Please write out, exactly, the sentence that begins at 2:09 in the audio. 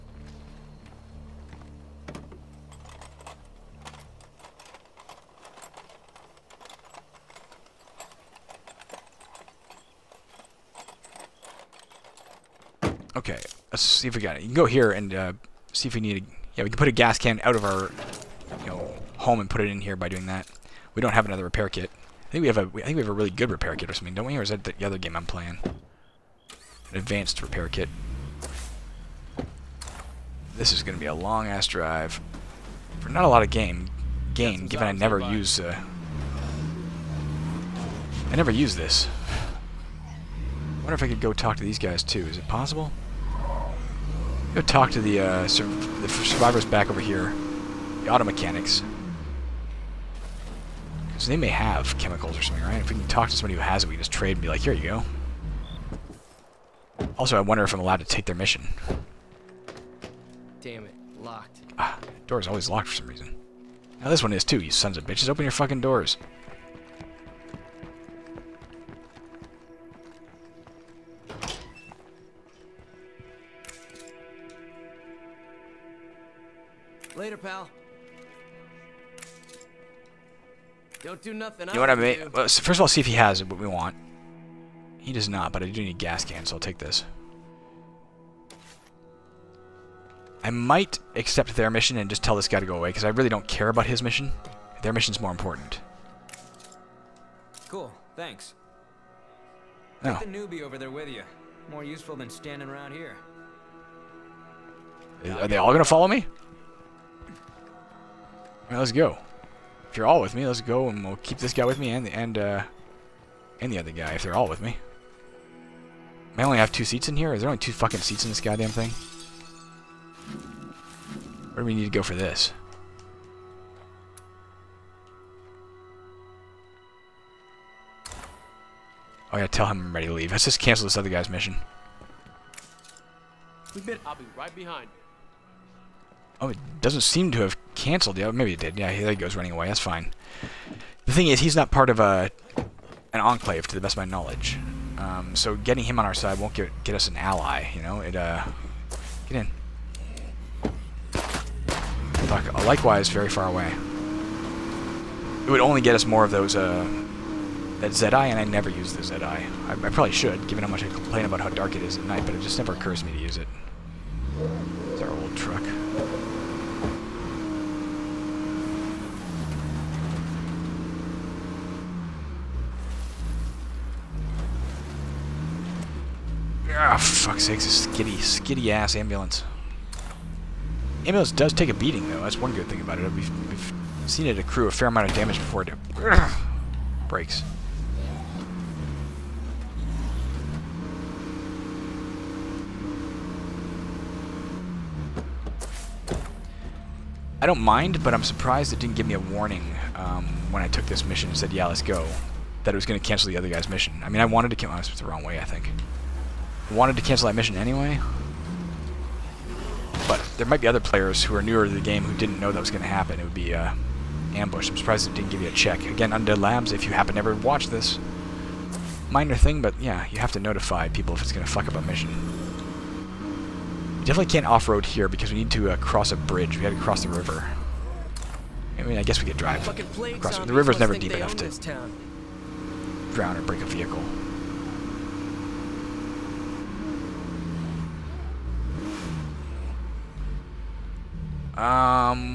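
Oh yeah, tell him I'm ready to leave.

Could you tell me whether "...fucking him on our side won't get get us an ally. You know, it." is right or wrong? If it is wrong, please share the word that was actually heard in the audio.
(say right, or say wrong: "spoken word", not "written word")
wrong: "getting", not "fucking".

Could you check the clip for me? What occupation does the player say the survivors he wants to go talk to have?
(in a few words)
Auto mechanics.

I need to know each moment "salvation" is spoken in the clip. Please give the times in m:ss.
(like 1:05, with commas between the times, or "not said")
not said.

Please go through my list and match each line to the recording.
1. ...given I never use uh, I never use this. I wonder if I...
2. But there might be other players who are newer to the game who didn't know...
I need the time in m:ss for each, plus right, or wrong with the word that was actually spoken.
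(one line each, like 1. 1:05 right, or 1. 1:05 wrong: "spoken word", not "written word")
1. 0:34 right
2. 3:30 right.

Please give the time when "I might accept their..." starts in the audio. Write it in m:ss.
1:30.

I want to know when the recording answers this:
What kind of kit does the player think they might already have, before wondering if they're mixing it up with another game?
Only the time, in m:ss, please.
0:25.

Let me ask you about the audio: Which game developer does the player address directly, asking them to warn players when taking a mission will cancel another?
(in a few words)
Undead Labs.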